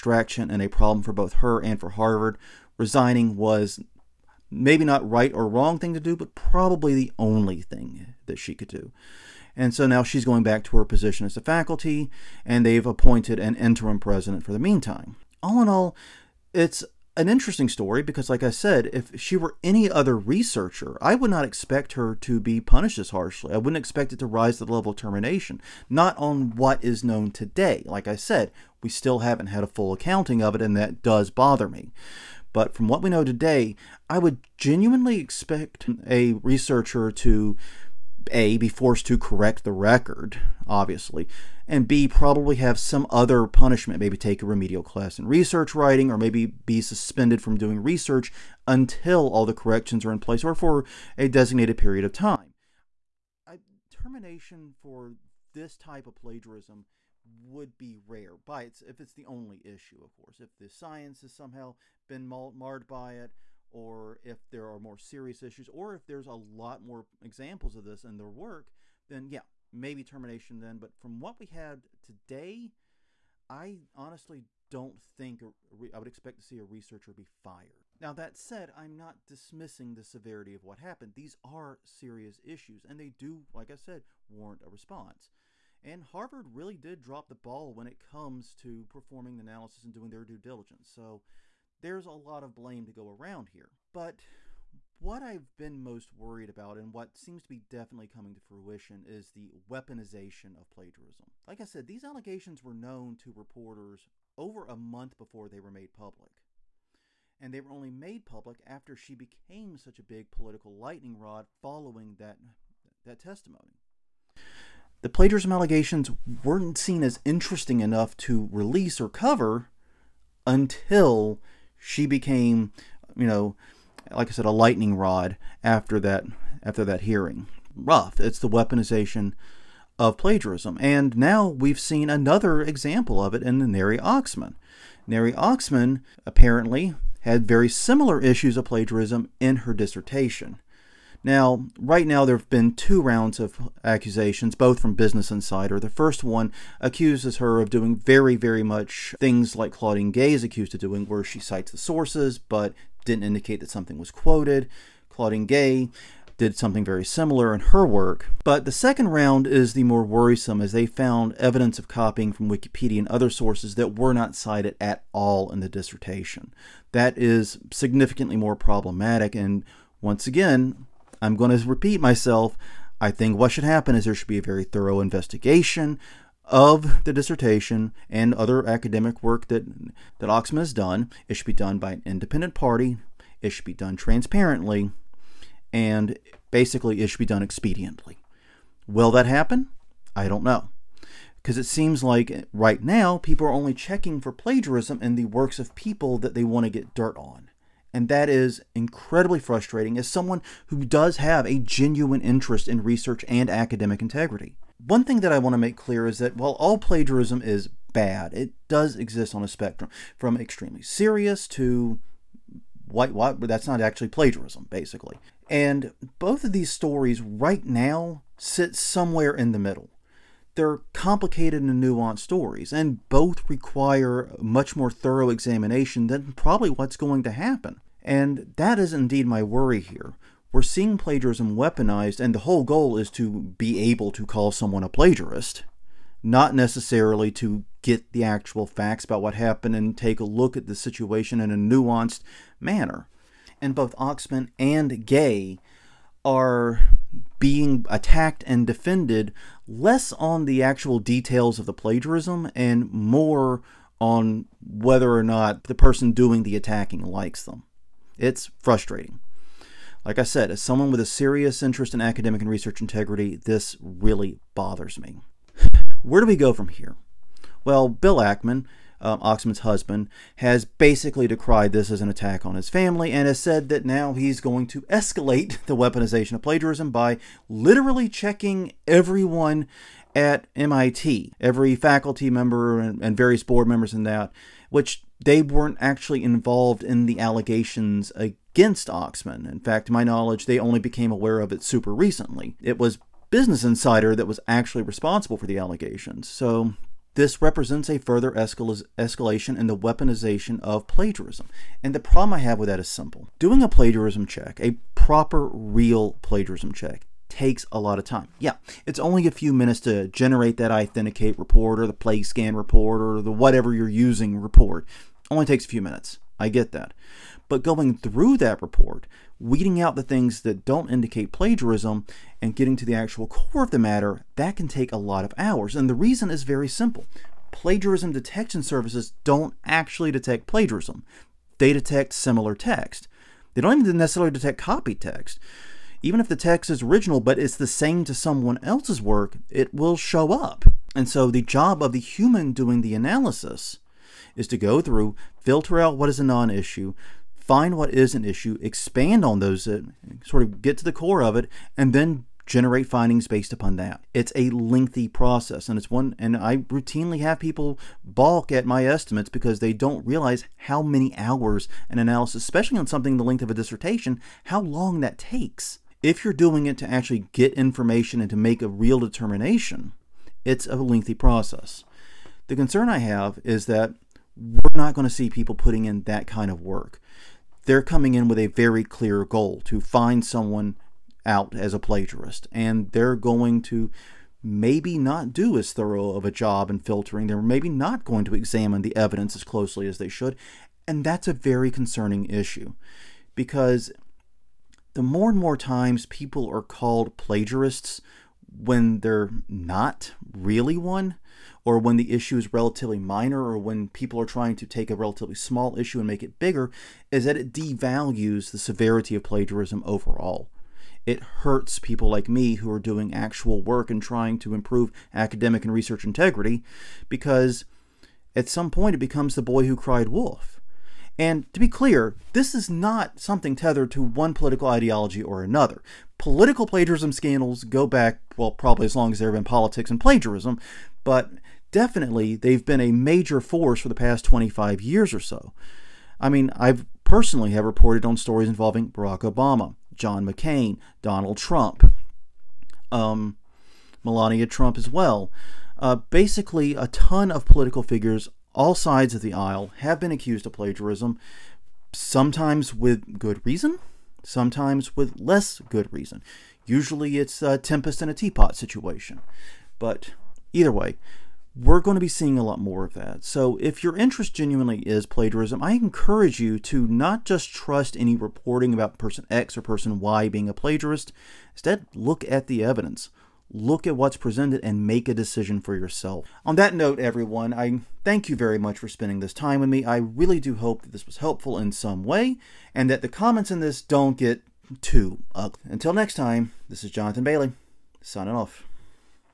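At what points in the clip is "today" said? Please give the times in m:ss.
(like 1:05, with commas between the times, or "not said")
0:27, 0:33, 1:12.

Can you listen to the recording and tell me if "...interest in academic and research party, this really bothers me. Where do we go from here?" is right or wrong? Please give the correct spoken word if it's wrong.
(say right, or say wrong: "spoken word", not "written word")
wrong: "integrity", not "party".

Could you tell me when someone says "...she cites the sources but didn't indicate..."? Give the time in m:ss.
2:31.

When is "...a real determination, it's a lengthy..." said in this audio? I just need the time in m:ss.
6:08.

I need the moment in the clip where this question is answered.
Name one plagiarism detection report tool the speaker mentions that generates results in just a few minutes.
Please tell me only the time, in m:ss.
5:10.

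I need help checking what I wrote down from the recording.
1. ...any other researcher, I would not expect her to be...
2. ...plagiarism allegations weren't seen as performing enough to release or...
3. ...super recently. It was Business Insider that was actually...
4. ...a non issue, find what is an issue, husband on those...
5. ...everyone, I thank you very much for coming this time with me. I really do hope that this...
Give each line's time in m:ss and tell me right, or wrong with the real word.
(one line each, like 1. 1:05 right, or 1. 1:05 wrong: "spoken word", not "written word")
1. 0:19 right
2. 1:55 wrong: "interesting", not "performing"
3. 4:51 right
4. 5:46 wrong: "expand", not "husband"
5. 7:56 wrong: "spending", not "coming".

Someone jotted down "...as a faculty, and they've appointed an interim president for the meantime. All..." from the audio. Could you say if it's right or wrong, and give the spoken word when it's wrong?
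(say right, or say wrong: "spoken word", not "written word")
right.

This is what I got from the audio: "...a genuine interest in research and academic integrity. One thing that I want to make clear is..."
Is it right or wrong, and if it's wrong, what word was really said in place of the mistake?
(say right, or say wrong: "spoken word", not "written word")
right.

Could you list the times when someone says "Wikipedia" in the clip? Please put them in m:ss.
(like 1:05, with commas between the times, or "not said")
2:42.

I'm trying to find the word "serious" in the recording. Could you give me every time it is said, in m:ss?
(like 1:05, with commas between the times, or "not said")
1:04, 1:21, 3:30, 4:21.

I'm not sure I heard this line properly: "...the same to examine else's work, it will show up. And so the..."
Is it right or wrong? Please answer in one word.
wrong.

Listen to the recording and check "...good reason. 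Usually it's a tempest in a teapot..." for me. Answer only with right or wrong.
right.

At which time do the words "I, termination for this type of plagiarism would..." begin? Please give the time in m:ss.
0:53.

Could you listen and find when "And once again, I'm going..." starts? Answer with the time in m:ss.
2:49.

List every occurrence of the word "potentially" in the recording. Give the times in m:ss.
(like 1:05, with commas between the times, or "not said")
not said.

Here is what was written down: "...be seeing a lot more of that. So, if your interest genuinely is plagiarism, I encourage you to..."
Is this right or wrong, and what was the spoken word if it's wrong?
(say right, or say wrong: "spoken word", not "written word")
right.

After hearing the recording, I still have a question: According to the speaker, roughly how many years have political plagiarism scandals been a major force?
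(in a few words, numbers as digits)
25.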